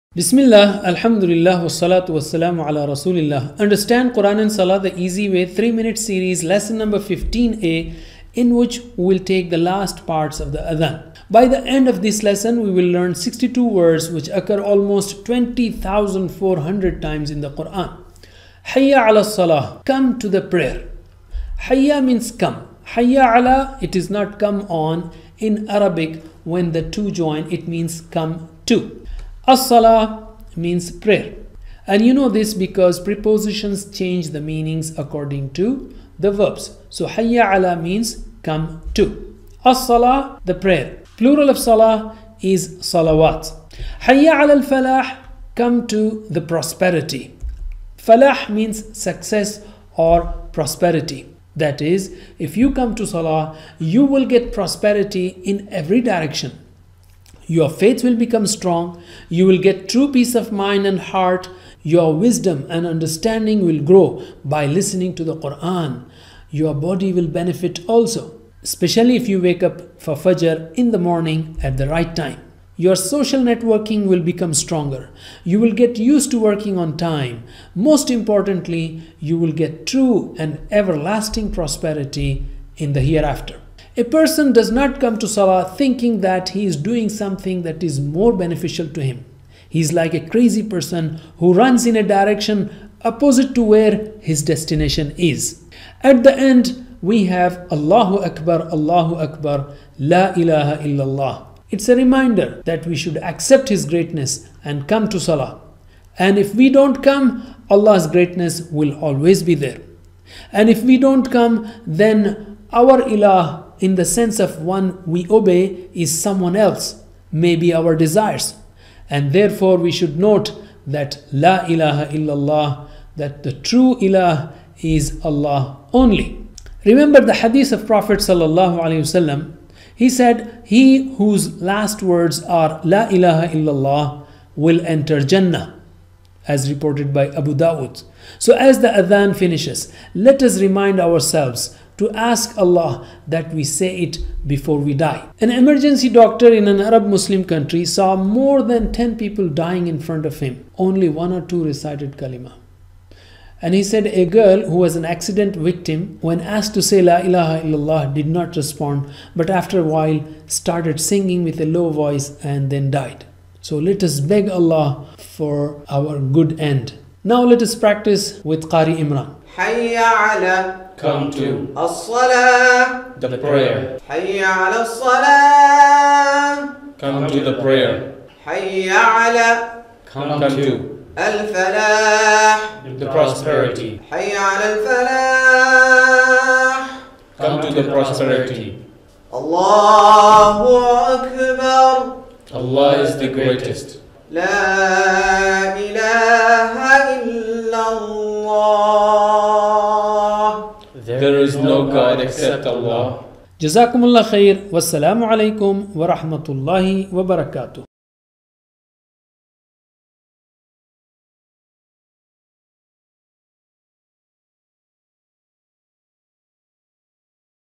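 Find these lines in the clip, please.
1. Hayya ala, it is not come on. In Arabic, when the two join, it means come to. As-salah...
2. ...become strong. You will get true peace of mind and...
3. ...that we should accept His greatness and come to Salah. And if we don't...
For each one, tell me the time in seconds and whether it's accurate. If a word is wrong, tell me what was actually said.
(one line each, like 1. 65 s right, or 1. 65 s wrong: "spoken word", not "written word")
1. 22 s right
2. 58 s right
3. 102 s right.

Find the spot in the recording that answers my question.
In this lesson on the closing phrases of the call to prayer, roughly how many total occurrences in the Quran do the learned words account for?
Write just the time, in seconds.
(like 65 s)
15 s.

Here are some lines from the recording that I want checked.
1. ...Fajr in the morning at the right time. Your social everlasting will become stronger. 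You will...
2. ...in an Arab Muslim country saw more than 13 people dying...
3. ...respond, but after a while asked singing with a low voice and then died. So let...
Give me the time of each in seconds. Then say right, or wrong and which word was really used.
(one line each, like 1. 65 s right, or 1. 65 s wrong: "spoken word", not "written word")
1. 70 s wrong: "networking", not "everlasting"
2. 146 s wrong: "10", not "13"
3. 158 s wrong: "started", not "asked".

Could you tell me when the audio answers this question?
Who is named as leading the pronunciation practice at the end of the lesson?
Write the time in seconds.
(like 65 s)
168 s.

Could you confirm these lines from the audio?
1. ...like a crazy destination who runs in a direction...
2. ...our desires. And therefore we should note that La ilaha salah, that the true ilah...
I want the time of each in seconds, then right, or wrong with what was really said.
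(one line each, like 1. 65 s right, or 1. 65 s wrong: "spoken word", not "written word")
1. 89 s wrong: "person", not "destination"
2. 117 s wrong: "illallah", not "salah".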